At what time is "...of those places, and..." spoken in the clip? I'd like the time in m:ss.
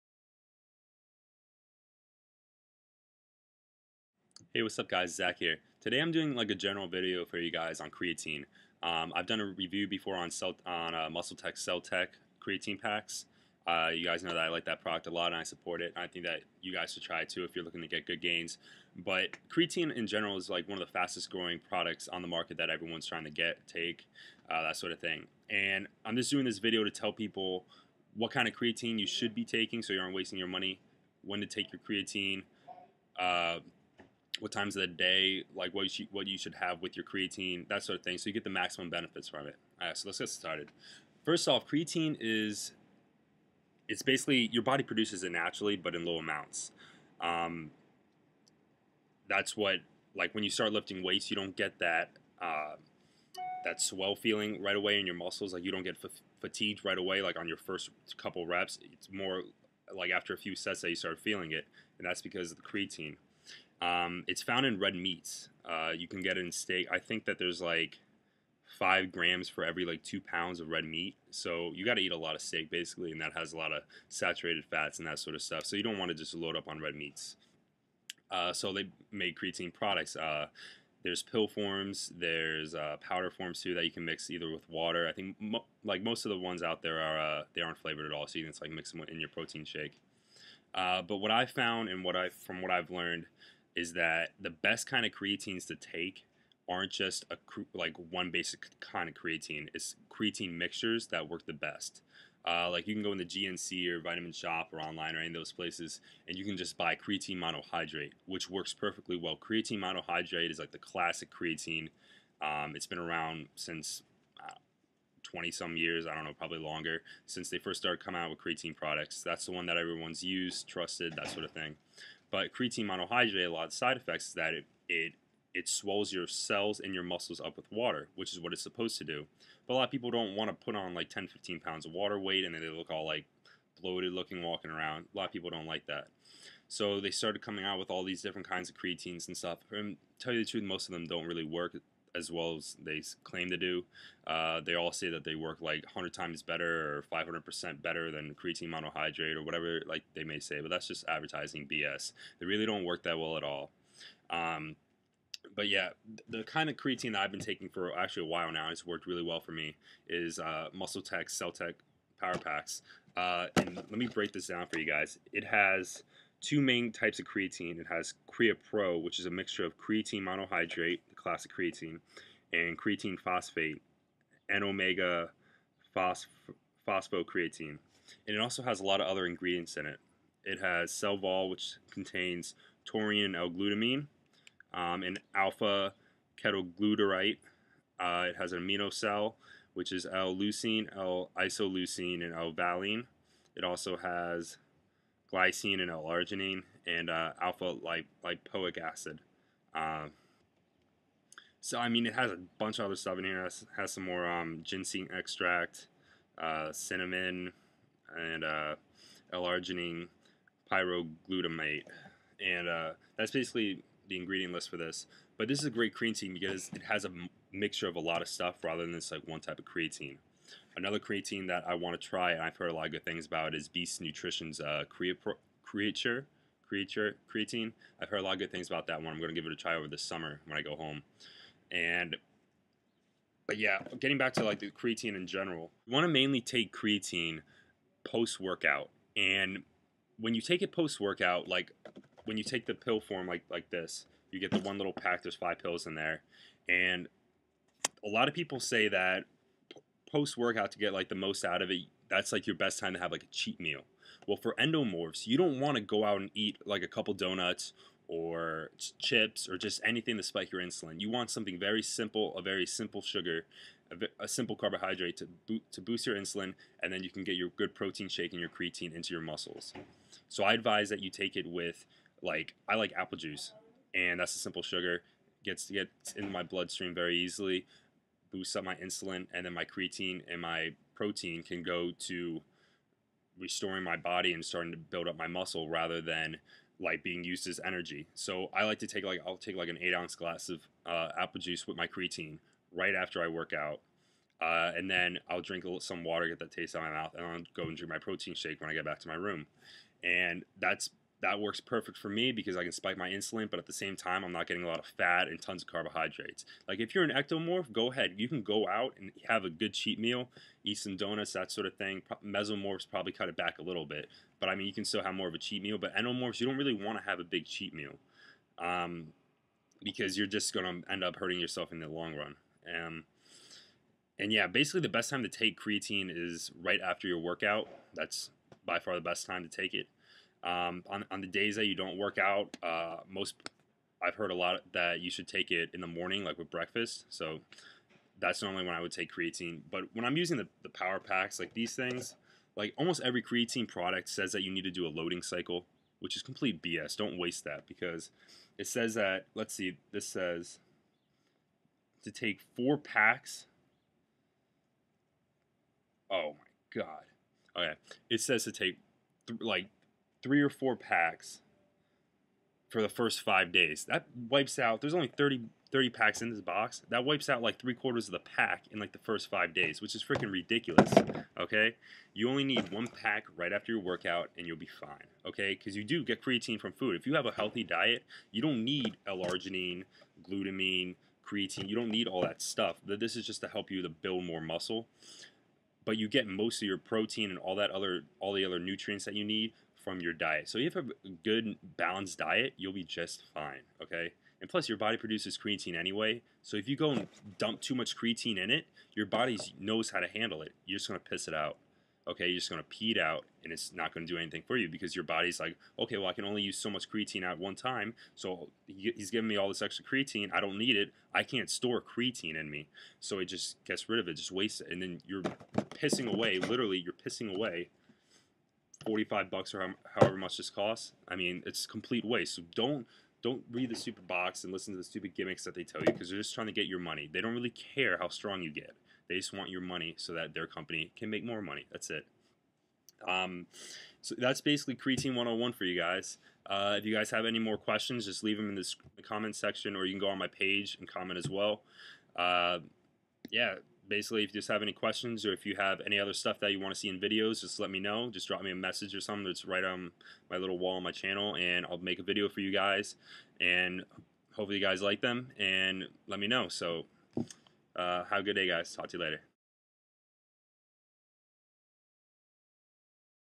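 1:45.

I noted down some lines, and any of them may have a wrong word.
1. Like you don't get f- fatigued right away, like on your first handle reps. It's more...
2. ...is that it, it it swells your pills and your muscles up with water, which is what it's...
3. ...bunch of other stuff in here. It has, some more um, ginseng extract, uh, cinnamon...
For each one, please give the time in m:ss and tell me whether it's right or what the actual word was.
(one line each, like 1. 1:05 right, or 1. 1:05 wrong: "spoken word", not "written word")
1. 0:55 wrong: "couple", not "handle"
2. 2:04 wrong: "cells", not "pills"
3. 3:22 right.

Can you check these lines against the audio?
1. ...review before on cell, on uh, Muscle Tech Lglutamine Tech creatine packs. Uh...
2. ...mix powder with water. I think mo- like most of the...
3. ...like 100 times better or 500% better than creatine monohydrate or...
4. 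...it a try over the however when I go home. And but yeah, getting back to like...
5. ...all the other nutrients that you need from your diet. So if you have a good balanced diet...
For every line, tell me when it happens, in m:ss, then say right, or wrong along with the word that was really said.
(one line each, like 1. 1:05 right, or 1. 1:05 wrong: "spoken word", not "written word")
1. 0:09 wrong: "Cell", not "Lglutamine"
2. 1:24 wrong: "either", not "powder"
3. 2:25 right
4. 3:49 wrong: "summer", not "however"
5. 6:28 right.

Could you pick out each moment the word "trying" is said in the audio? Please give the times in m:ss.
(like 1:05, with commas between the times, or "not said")
0:23, 7:06.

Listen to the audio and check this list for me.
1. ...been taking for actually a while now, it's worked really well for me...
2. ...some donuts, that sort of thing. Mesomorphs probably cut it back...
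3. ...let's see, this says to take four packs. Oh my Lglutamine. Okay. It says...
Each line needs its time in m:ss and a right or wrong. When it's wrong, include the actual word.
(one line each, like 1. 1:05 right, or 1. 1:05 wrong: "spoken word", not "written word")
1. 2:37 right
2. 5:10 right
3. 5:49 wrong: "God", not "Lglutamine".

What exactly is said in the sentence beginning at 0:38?
So you get the maximum benefits from it.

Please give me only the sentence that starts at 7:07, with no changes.
They don't really care how strong you get.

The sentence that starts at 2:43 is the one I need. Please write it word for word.
Uh, and let me break this down for you guys.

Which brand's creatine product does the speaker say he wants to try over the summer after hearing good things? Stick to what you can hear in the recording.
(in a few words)
Beast Nutrition.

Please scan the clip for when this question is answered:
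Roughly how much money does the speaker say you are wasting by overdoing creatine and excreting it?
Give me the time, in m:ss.
6:58.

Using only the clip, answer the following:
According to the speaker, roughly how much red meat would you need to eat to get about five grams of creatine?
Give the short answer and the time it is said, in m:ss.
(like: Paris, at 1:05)
2 pounds, at 1:10.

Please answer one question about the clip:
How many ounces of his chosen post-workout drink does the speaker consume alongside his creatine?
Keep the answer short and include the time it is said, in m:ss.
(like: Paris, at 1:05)
8, at 4:49.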